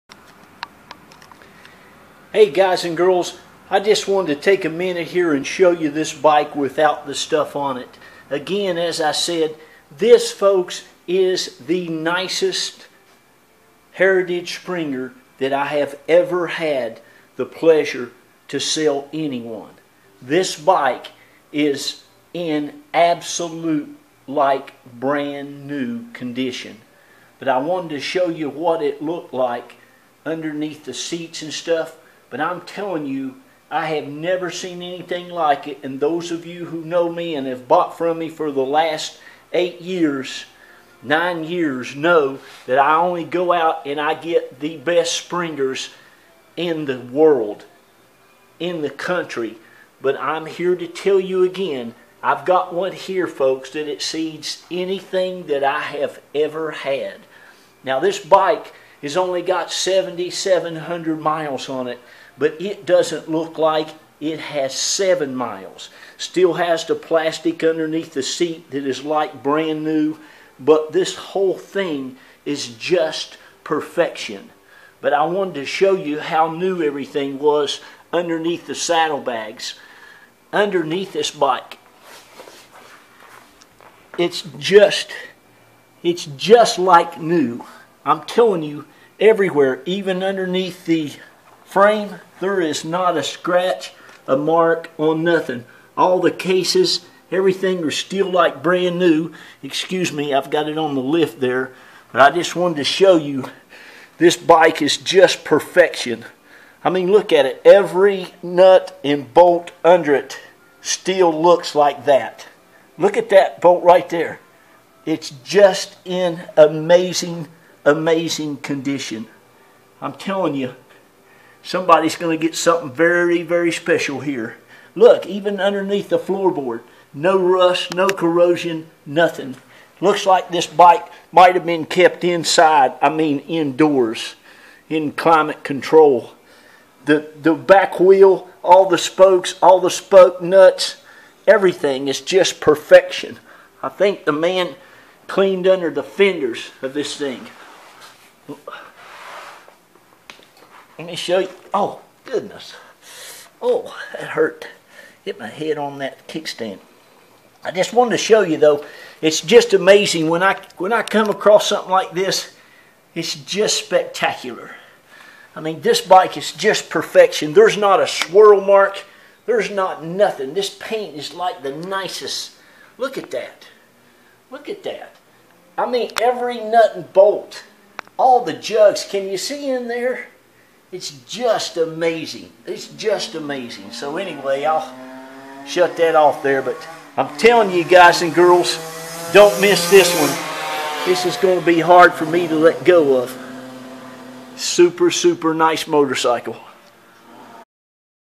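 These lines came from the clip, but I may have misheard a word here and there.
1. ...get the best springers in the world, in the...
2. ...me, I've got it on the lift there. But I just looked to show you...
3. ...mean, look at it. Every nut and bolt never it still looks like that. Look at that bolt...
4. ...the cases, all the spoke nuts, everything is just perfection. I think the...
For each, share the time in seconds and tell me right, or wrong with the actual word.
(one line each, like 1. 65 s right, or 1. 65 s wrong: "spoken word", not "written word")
1. 44 s right
2. 100 s wrong: "wanted", not "looked"
3. 106 s wrong: "under", not "never"
4. 138 s wrong: "spokes", not "cases".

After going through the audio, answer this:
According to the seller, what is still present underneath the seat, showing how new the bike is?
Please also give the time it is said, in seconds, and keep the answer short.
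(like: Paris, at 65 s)
plastic, at 66 s.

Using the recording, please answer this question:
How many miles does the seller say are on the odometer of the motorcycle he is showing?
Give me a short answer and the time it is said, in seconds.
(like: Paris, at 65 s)
7,700, at 59 s.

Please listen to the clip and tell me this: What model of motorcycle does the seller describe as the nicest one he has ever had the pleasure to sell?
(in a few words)
Heritage Springer.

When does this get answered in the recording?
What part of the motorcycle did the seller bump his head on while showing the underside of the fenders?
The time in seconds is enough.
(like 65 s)
156 s.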